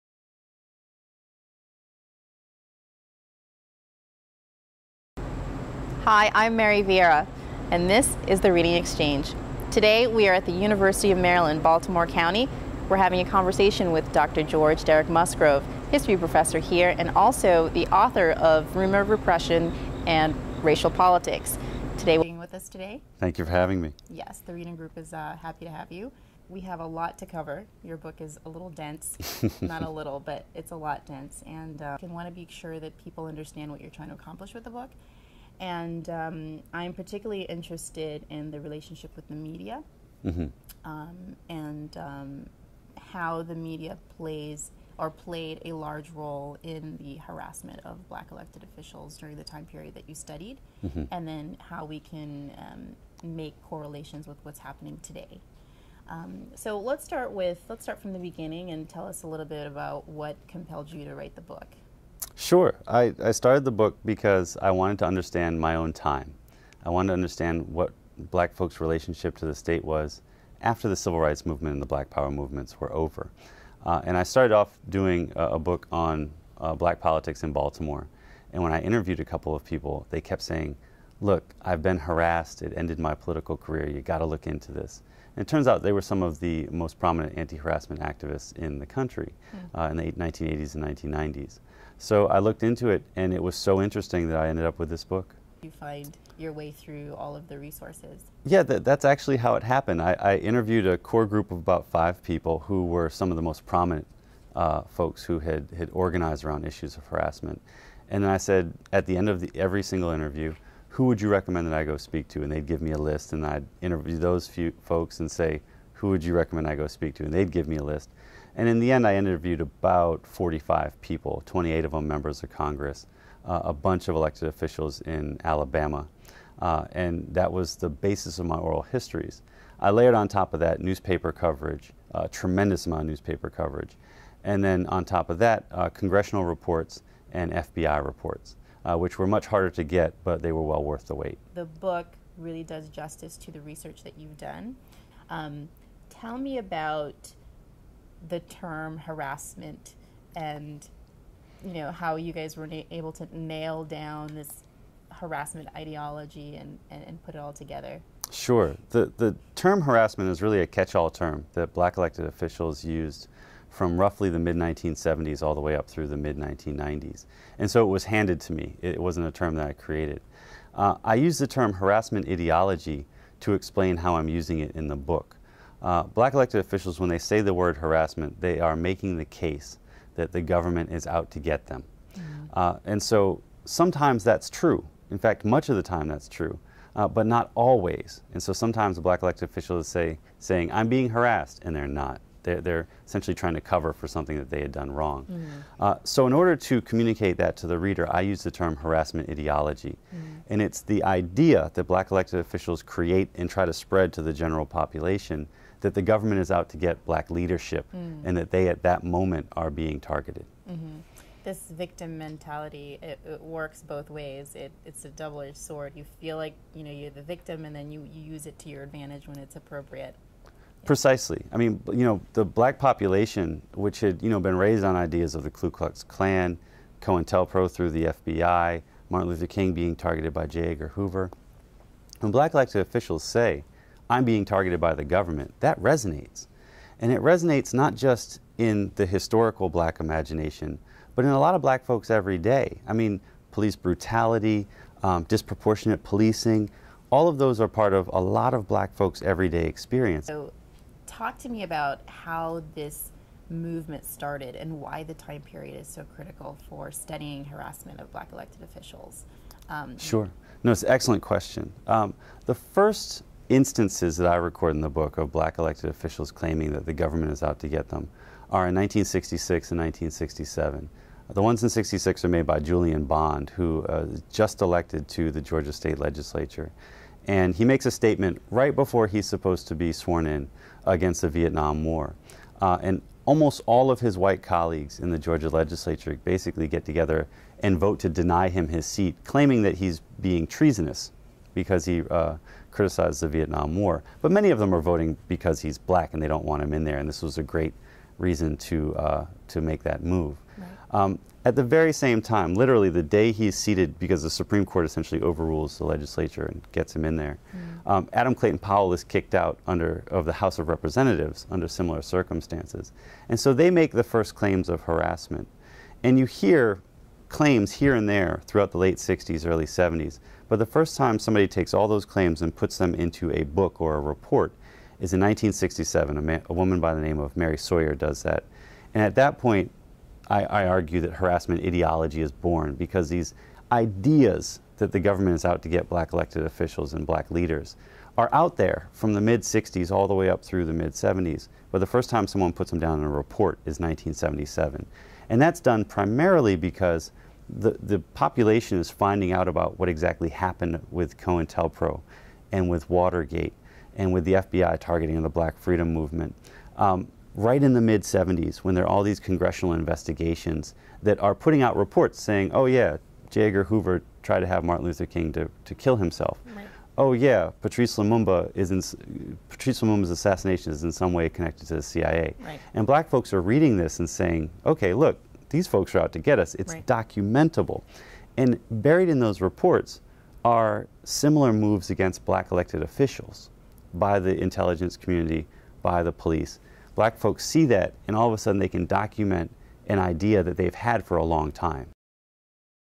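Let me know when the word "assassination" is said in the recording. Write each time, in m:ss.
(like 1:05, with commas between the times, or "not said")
6:10.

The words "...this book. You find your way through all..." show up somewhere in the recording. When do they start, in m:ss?
1:34.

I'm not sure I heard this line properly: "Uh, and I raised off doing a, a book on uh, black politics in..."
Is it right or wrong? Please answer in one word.
wrong.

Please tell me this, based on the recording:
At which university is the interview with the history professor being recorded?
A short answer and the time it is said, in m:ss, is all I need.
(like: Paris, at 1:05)
University of Maryland, Baltimore County, at 0:10.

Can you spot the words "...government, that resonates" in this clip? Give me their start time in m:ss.
3:55.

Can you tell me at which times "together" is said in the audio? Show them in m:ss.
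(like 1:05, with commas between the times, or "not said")
2:37, 4:46.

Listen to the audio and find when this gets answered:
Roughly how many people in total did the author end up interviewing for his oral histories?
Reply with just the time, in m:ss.
1:59.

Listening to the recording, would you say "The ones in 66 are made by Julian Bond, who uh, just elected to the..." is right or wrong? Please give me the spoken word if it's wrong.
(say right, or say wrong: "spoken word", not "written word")
right.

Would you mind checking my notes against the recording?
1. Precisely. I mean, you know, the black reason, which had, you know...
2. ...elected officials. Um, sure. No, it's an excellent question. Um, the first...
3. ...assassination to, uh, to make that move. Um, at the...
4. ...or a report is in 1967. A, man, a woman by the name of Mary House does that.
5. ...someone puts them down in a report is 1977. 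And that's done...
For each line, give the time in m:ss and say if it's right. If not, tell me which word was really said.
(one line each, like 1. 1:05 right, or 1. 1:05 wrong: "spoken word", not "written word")
1. 3:40 wrong: "population", not "reason"
2. 4:18 right
3. 4:58 wrong: "reason", not "assassination"
4. 5:23 wrong: "Sawyer", not "House"
5. 5:42 right.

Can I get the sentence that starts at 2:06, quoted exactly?
Uh, and that was the basis of my oral histories.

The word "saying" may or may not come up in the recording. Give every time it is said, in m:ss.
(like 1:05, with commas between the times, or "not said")
1:20, 3:10, 6:02, 6:14.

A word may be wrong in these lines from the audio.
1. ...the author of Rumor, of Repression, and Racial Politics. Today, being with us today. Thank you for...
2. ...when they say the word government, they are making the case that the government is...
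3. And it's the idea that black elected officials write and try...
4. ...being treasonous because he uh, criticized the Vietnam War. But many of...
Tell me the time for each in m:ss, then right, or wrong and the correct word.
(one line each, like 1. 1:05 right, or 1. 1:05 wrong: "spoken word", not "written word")
1. 0:17 right
2. 2:56 wrong: "harassment", not "government"
3. 3:20 wrong: "create", not "write"
4. 4:50 right.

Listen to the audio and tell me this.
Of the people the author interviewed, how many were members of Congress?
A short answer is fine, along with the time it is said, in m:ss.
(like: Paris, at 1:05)
28, at 2:01.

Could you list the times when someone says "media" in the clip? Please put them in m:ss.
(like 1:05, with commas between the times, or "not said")
0:39, 0:43.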